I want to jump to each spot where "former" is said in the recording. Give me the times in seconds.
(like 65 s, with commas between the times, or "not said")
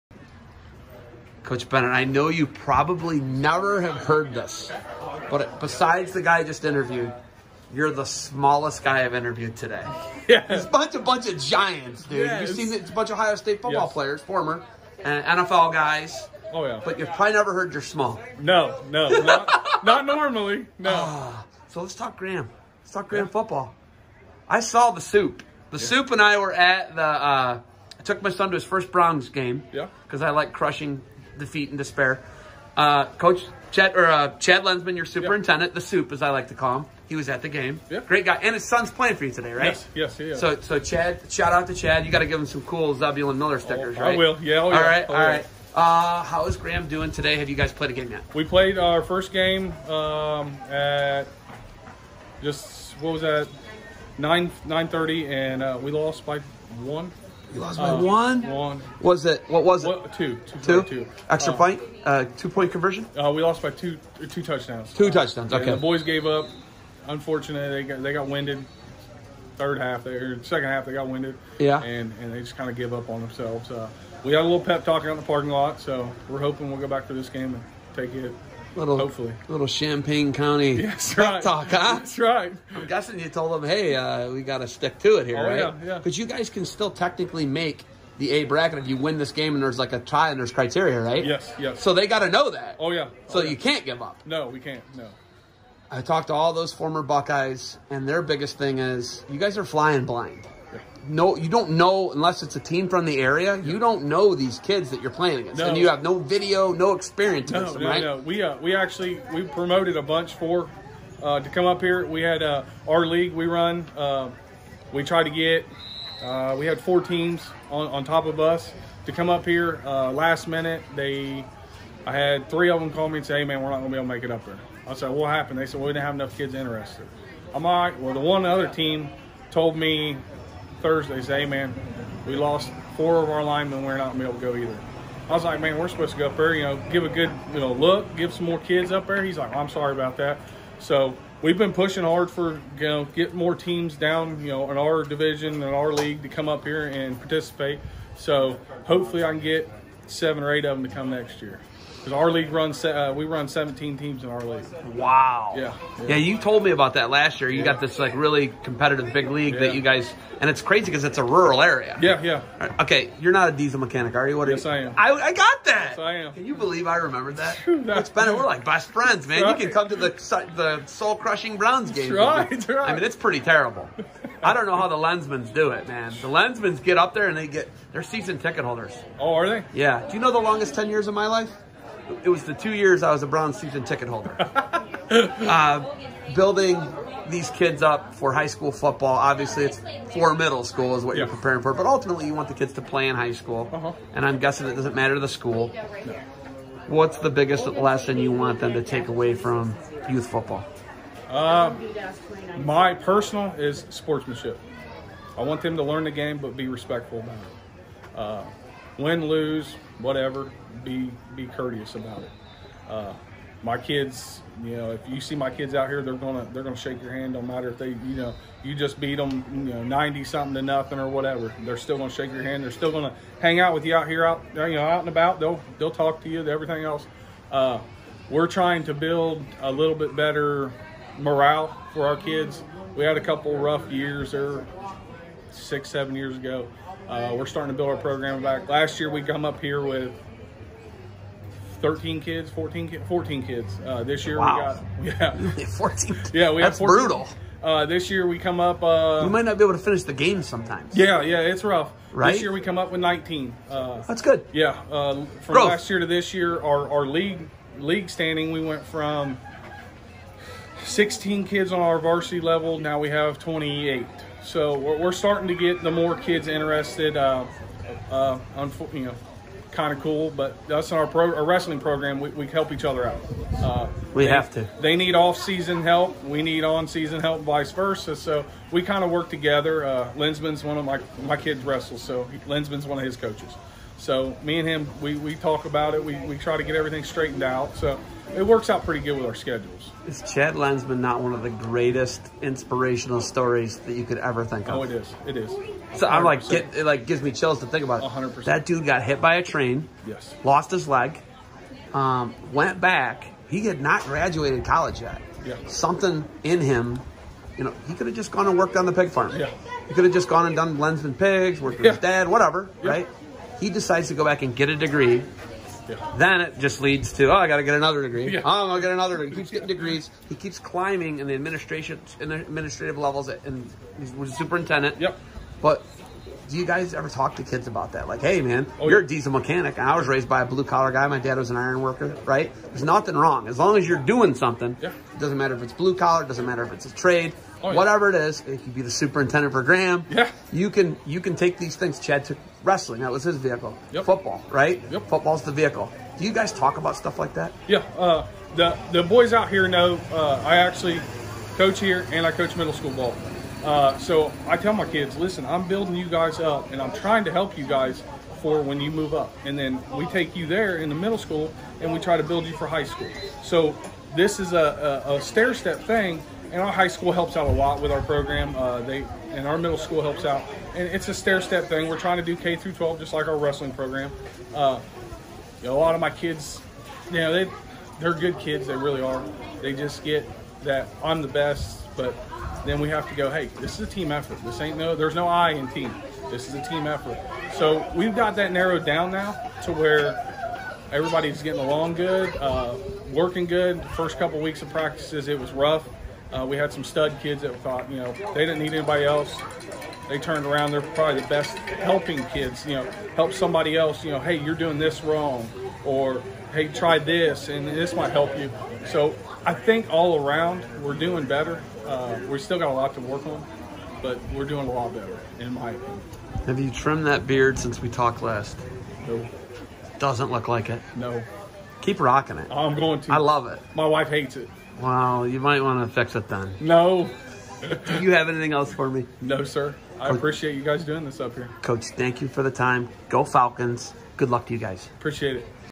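14 s, 96 s.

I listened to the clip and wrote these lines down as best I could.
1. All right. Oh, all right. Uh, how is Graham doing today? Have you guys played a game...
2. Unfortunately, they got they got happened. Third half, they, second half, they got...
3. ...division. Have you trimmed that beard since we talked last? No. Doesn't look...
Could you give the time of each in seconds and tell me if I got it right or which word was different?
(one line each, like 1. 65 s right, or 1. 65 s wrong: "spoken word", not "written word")
1. 44 s right
2. 67 s wrong: "winded", not "happened"
3. 415 s wrong: "opinion", not "division".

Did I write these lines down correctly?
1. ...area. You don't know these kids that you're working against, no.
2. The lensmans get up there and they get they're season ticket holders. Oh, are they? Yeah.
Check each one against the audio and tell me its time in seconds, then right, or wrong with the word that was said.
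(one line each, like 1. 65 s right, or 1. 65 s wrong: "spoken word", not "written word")
1. 103 s wrong: "playing", not "working"
2. 176 s right.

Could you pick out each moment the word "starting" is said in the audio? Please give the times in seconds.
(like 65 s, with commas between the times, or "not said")
237 s, 265 s.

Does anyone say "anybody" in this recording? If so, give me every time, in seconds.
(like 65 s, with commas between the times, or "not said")
398 s.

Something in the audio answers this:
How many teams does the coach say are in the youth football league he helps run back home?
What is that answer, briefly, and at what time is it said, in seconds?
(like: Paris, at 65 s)
17, at 153 s.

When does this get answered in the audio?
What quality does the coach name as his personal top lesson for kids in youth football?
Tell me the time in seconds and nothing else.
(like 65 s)
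203 s.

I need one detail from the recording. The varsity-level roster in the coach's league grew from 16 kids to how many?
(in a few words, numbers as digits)
28.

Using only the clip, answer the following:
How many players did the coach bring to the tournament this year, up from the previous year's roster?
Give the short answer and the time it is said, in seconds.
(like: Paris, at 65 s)
19, at 253 s.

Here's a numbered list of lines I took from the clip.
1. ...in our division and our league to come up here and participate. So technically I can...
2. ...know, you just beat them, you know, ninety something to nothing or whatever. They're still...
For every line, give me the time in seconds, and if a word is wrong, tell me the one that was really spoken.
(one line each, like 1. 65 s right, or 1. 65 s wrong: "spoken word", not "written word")
1. 144 s wrong: "hopefully", not "technically"
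2. 218 s right.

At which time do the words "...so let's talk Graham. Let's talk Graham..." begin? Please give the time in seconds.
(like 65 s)
21 s.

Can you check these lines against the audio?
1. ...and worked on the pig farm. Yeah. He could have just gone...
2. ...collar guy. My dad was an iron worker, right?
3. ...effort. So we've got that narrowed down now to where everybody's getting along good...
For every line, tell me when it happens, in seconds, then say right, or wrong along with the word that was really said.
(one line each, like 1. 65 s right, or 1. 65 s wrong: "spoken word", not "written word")
1. 308 s right
2. 330 s right
3. 386 s right.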